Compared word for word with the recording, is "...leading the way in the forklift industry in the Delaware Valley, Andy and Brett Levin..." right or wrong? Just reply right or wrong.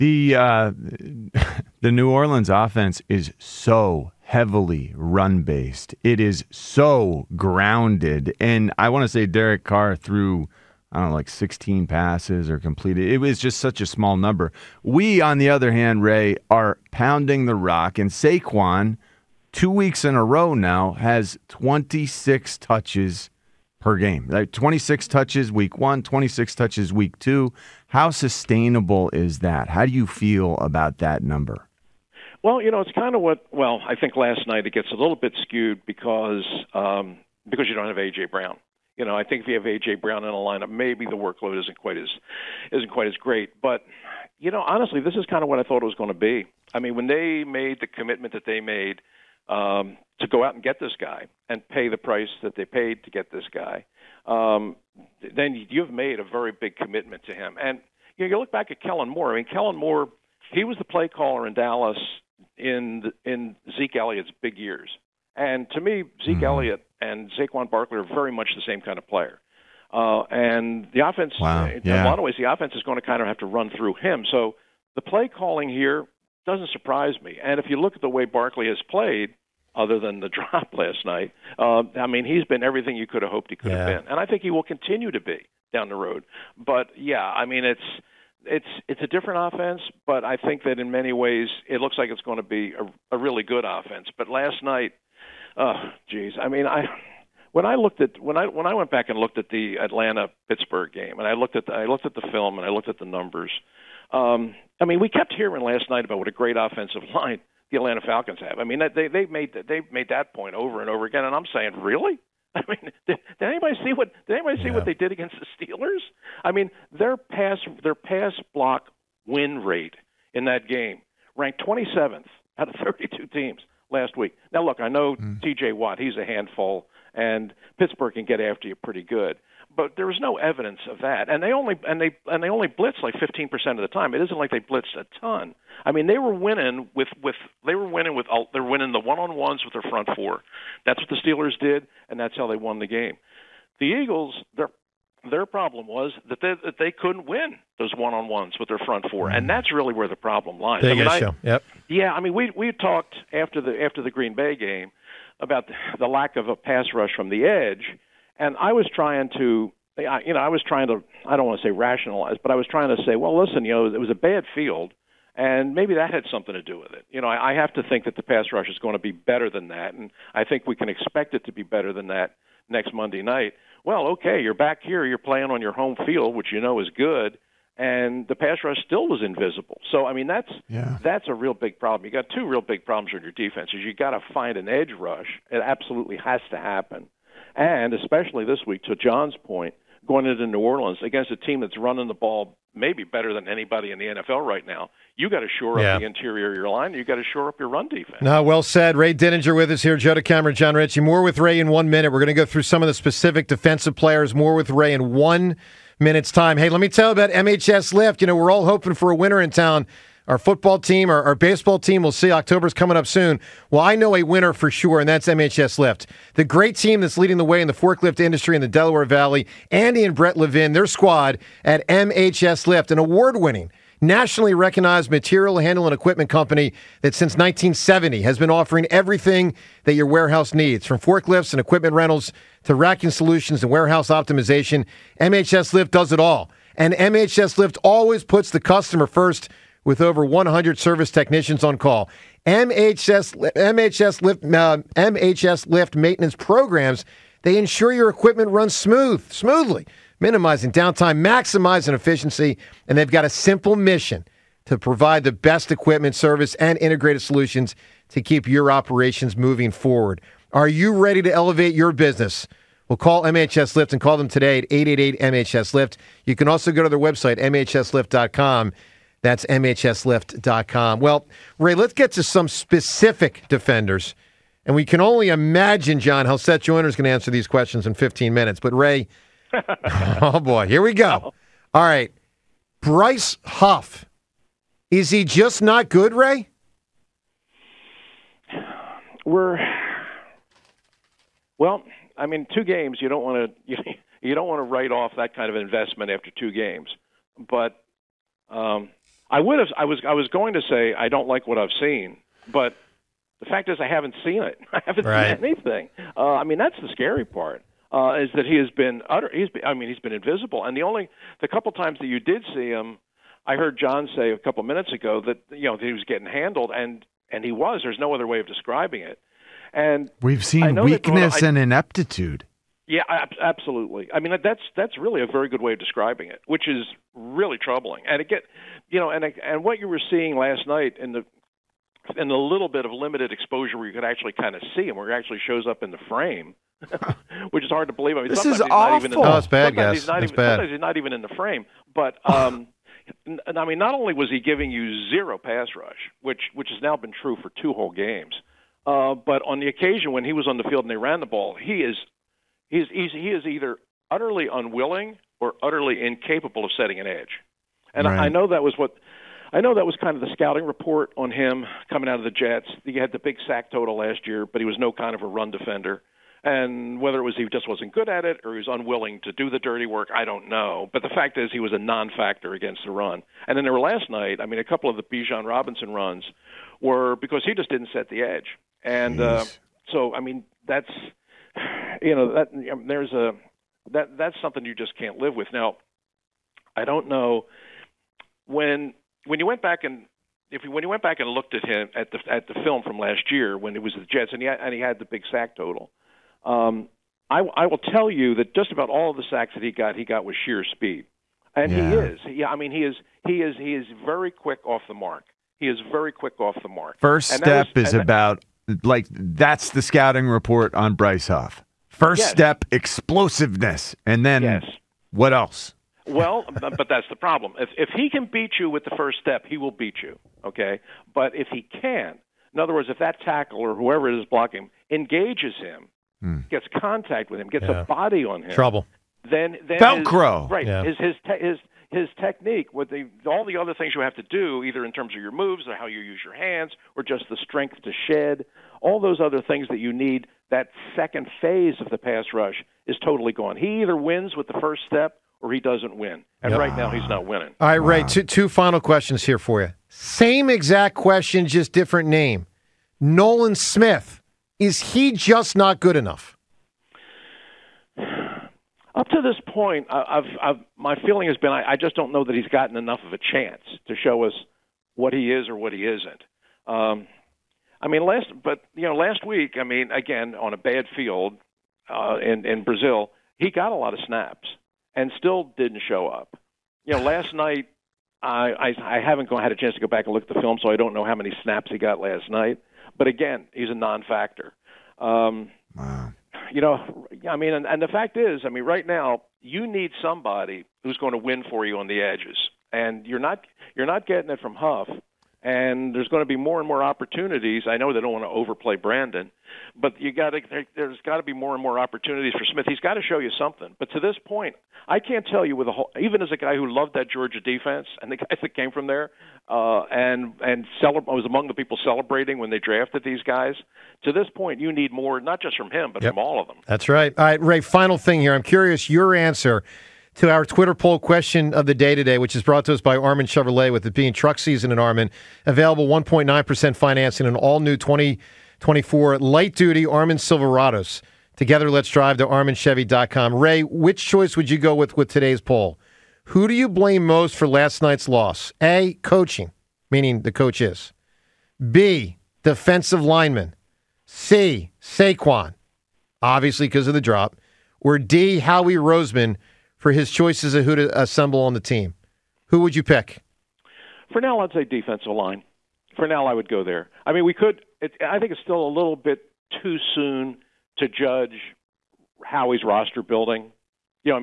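right.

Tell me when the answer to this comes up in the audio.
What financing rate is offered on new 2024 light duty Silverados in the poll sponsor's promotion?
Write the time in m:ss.
8:45.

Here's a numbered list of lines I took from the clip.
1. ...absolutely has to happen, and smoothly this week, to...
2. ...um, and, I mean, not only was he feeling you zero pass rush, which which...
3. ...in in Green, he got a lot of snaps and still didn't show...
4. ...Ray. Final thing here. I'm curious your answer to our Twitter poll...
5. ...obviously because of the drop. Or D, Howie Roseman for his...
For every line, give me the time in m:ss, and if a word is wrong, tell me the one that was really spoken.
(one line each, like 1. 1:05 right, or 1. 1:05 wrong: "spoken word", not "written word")
1. 3:05 wrong: "especially", not "smoothly"
2. 5:42 wrong: "giving", not "feeling"
3. 7:52 wrong: "Brazil", not "Green"
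4. 8:37 right
5. 9:06 right.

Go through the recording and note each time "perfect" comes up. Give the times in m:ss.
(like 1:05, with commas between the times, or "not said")
not said.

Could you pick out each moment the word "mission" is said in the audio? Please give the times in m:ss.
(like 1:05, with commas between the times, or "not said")
4:13.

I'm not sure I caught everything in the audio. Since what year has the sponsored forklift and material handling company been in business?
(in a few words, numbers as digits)
1970.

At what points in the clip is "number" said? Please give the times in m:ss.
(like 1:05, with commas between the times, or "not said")
0:14, 0:31, 1:43.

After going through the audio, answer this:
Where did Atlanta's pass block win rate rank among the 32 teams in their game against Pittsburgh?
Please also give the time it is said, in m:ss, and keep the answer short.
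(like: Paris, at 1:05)
27th, at 2:01.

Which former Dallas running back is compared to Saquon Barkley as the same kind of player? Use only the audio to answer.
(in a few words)
Zeke Elliott.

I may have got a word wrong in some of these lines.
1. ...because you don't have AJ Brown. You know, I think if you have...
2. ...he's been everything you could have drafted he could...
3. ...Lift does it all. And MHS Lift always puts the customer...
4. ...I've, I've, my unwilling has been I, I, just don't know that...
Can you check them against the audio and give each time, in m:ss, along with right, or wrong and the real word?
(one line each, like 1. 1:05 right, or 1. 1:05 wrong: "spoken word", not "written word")
1. 0:37 right
2. 1:22 wrong: "hoped", not "drafted"
3. 3:55 right
4. 7:39 wrong: "feeling", not "unwilling".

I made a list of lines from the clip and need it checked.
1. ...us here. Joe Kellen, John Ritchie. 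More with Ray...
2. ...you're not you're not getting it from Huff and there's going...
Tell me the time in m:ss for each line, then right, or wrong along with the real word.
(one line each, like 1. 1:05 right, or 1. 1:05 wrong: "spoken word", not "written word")
1. 3:19 wrong: "DeCamara", not "Kellen"
2. 8:13 right.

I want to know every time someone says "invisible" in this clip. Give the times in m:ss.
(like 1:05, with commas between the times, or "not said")
2:59, 5:10.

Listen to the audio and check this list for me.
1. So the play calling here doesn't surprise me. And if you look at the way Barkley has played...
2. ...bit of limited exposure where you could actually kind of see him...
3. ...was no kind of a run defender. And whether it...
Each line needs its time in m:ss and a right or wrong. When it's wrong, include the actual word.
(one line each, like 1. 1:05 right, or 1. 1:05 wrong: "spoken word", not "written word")
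1. 1:14 right
2. 5:32 right
3. 6:04 right.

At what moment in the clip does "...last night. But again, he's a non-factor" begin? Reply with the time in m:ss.
8:01.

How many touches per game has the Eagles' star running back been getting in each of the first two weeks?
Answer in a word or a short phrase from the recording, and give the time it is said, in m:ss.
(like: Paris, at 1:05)
26, at 0:21.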